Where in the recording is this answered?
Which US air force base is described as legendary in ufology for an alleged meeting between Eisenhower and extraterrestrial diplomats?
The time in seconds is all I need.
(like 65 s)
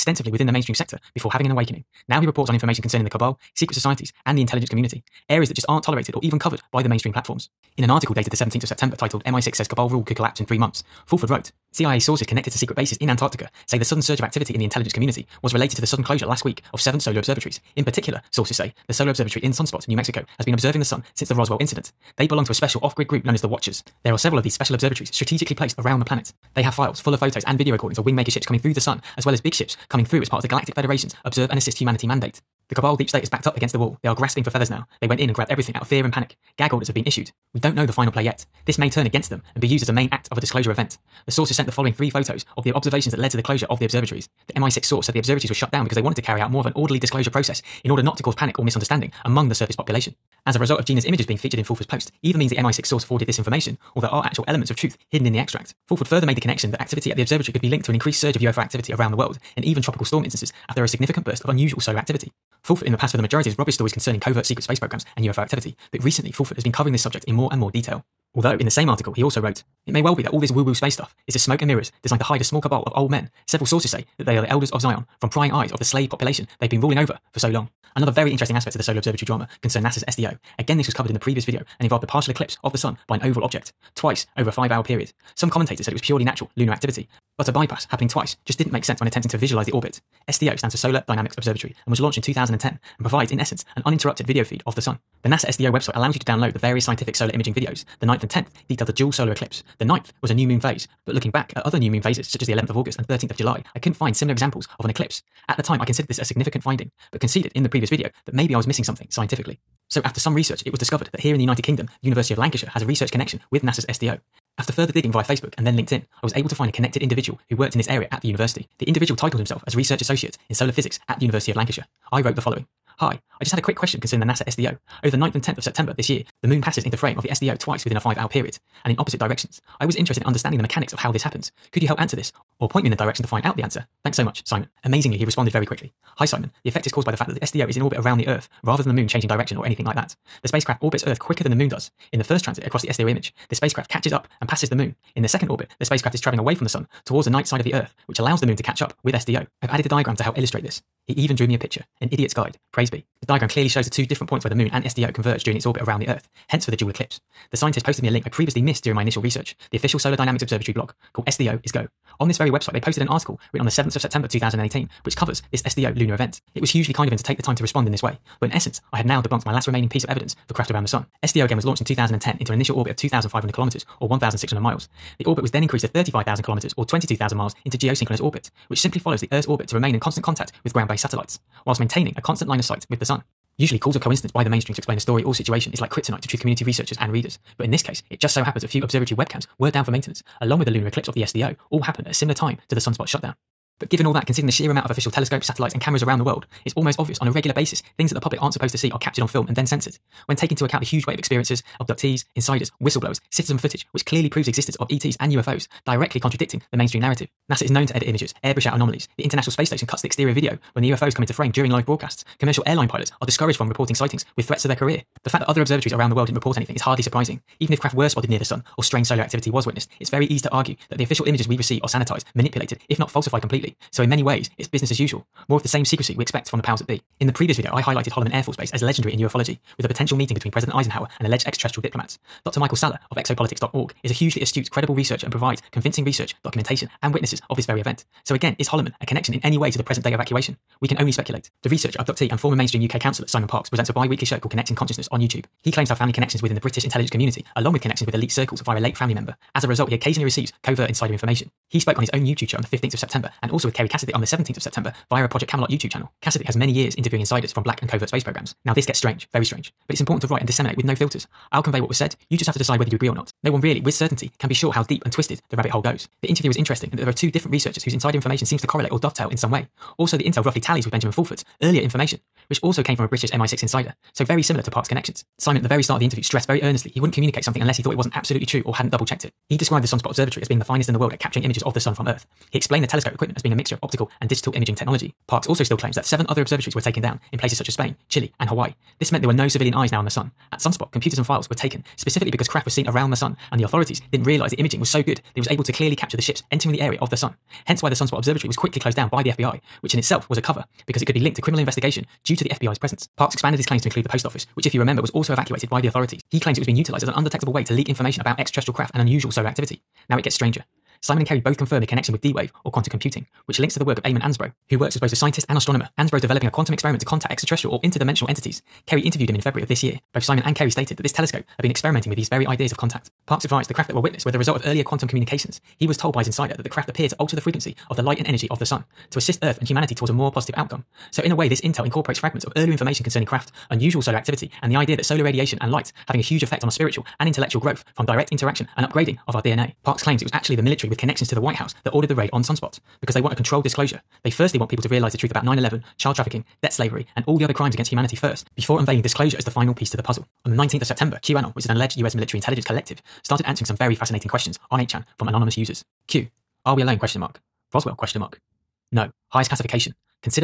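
228 s.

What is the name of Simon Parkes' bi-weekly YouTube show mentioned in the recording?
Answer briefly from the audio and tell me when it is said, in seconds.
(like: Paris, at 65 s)
Connecting Consciousness, at 244 s.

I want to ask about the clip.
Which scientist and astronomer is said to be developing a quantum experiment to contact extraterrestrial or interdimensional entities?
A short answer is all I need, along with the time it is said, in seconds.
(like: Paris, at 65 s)
Eamon Ansbro, at 314 s.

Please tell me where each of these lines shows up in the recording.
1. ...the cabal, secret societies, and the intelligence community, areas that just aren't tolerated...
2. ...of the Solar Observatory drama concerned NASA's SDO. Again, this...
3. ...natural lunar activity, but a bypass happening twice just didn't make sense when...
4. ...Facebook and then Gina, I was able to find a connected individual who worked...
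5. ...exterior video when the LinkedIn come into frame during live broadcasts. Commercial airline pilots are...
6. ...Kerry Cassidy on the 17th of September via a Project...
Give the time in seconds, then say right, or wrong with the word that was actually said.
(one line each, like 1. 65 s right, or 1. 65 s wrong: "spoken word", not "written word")
1. 3 s right
2. 78 s right
3. 86 s right
4. 115 s wrong: "LinkedIn", not "Gina"
5. 210 s wrong: "UFOs", not "LinkedIn"
6. 253 s right.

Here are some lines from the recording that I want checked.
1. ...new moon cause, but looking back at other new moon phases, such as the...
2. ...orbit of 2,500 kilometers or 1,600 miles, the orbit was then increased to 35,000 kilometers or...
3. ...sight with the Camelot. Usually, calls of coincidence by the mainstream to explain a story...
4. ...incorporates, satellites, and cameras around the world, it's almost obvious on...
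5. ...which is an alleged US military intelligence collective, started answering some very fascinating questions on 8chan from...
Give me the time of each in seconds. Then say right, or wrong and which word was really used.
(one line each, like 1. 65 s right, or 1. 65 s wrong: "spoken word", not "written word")
1. 100 s wrong: "phase", not "cause"
2. 172 s right
3. 182 s wrong: "Sun", not "Camelot"
4. 195 s wrong: "telescopes", not "incorporates"
5. 351 s right.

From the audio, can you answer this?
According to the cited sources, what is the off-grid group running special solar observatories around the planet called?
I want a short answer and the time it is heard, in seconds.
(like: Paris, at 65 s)
The Watchers, at 23 s.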